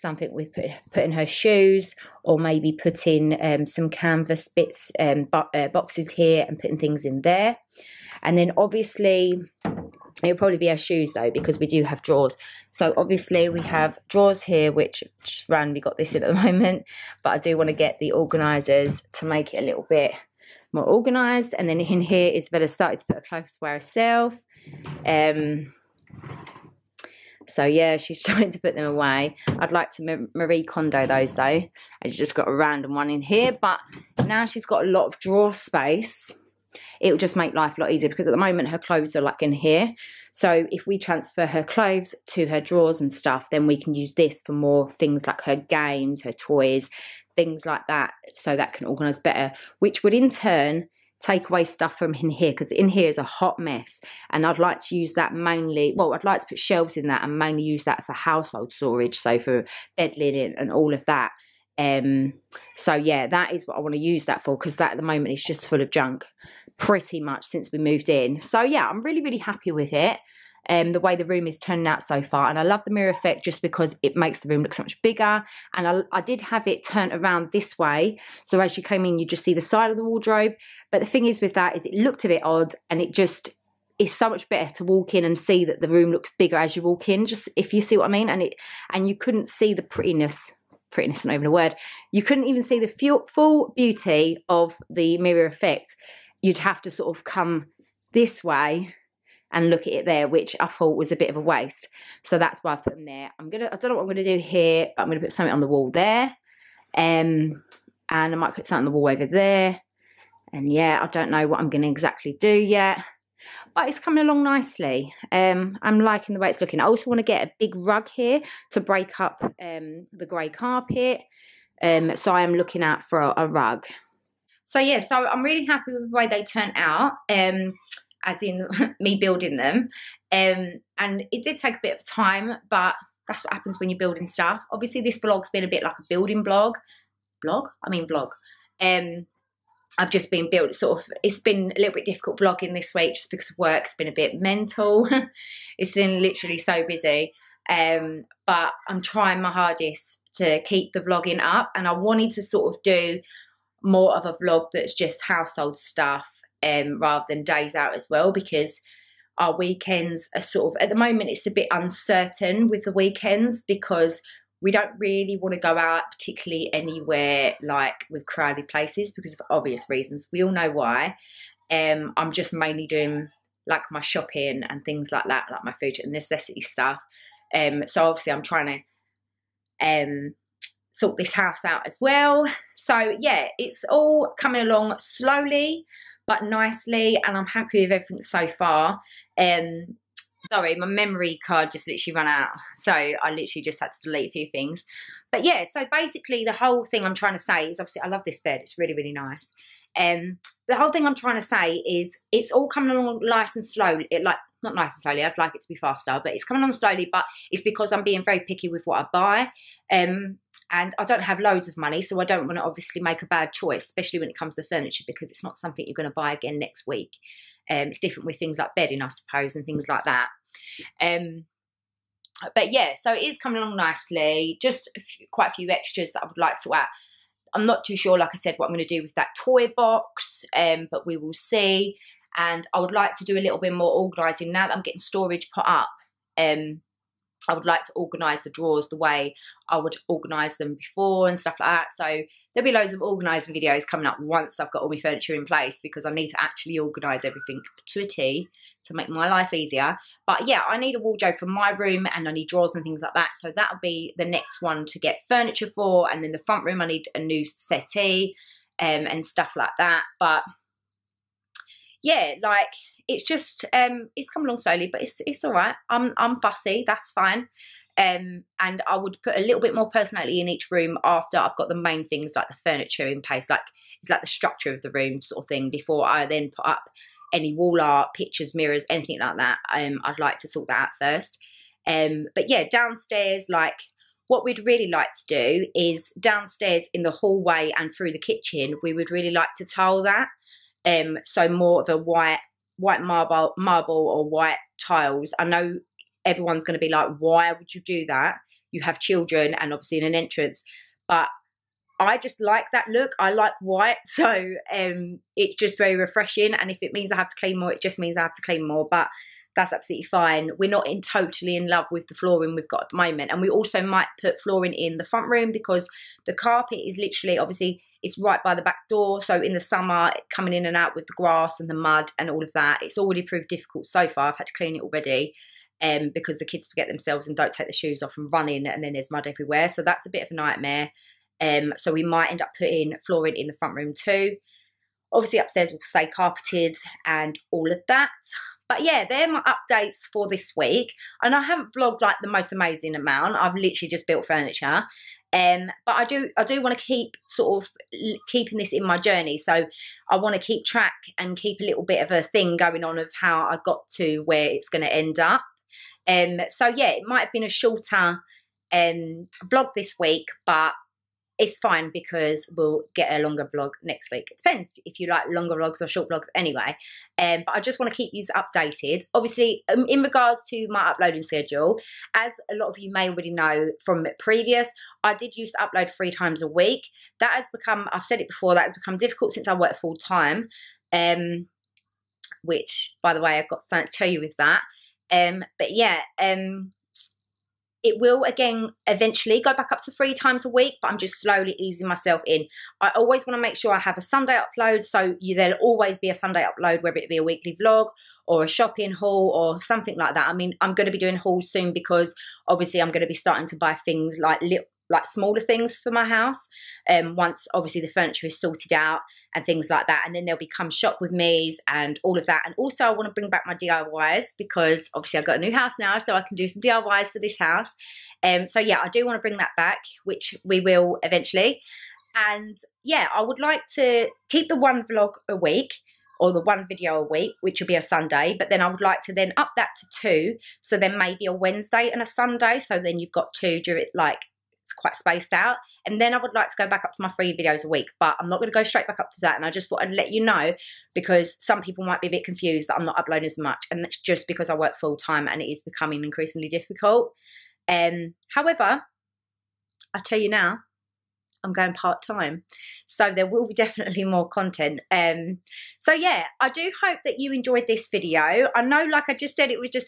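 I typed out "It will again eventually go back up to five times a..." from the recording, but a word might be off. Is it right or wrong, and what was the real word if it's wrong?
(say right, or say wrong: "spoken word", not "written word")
wrong: "three", not "five".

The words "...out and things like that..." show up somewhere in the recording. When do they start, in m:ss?
6:48.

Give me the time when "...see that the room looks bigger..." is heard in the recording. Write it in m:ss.
1:25.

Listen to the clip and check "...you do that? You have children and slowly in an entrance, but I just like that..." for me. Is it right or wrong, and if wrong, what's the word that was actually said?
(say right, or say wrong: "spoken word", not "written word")
wrong: "obviously", not "slowly".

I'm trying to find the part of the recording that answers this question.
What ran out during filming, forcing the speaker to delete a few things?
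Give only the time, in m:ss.
3:10.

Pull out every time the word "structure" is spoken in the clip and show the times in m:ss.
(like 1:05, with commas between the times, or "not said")
4:34.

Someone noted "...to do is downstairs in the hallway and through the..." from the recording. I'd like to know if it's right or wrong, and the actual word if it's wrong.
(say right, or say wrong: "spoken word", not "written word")
right.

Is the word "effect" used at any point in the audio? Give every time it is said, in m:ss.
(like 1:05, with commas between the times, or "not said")
1:13, 1:35.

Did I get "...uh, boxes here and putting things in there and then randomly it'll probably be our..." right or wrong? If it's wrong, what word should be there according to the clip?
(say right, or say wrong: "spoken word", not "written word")
wrong: "obviously", not "randomly".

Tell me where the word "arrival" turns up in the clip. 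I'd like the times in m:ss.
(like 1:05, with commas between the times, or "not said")
not said.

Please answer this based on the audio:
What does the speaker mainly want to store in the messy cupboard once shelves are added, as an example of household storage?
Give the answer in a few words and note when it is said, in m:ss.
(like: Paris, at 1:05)
Bed linen, at 0:59.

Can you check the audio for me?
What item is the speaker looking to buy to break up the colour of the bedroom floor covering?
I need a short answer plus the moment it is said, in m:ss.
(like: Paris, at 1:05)
A big rug, at 1:57.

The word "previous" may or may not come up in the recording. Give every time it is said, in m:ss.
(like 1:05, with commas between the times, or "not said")
6:14.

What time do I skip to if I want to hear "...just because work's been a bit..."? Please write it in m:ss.
2:23.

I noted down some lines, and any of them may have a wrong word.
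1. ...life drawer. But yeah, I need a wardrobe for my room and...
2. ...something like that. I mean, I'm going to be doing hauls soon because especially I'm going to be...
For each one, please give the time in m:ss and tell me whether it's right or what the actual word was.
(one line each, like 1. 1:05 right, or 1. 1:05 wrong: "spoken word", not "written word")
1. 4:09 wrong: "easier", not "drawer"
2. 6:39 wrong: "obviously", not "especially".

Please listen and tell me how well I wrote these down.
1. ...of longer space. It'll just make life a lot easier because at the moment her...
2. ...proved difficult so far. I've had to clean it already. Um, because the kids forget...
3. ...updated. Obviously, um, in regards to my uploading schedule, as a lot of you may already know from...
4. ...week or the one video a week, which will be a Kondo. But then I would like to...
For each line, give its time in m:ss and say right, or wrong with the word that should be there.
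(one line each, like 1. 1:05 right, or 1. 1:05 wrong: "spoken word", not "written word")
1. 0:35 wrong: "drawer", not "longer"
2. 5:23 right
3. 6:08 right
4. 7:05 wrong: "Sunday", not "Kondo".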